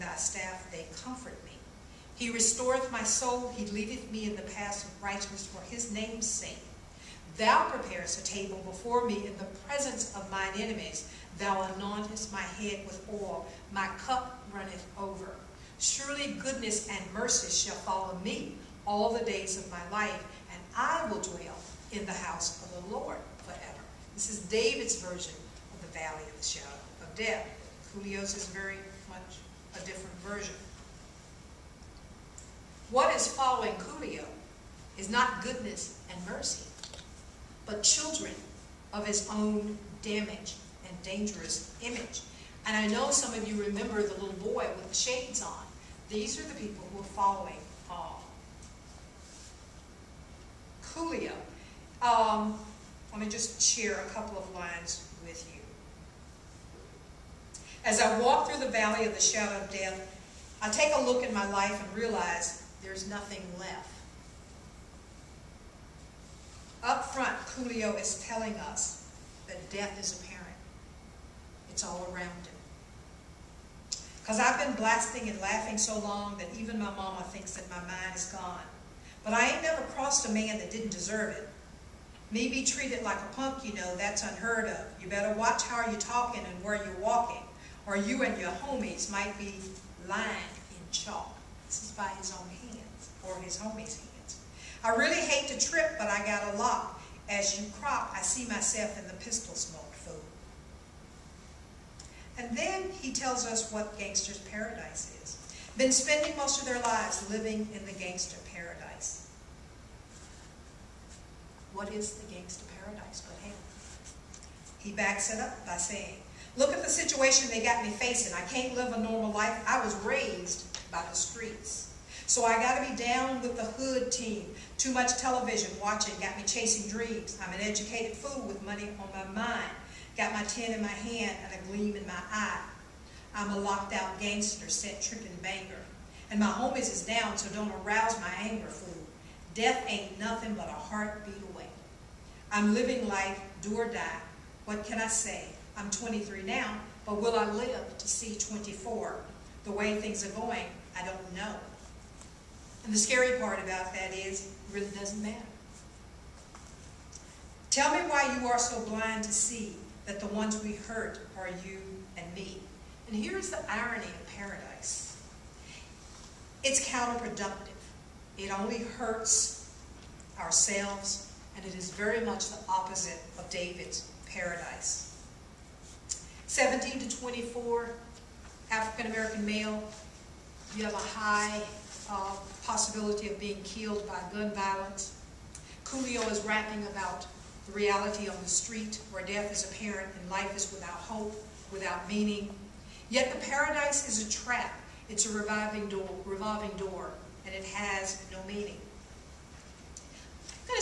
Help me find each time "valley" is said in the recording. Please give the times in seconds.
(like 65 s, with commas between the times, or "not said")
25 s, 58 s.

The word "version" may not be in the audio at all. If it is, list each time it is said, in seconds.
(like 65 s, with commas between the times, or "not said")
25 s, 30 s.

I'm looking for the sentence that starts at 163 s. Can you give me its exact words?
And here's the irony of paradise.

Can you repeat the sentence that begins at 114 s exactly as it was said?
He backs it up by saying, look at the situation they got me facing.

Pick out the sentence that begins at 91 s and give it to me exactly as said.
This is by his own hands, or his homies' hands.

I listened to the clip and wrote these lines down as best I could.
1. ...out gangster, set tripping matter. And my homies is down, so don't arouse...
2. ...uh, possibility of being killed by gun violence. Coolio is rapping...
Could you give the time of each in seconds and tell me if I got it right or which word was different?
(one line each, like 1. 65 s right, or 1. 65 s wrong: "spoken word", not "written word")
1. 133 s wrong: "banger", not "matter"
2. 182 s right.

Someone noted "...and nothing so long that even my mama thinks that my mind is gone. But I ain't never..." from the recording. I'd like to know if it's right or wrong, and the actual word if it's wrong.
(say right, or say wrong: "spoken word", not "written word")
wrong: "laughing", not "nothing".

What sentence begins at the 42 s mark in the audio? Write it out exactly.
And I know some of you remember the little boy with the shades on.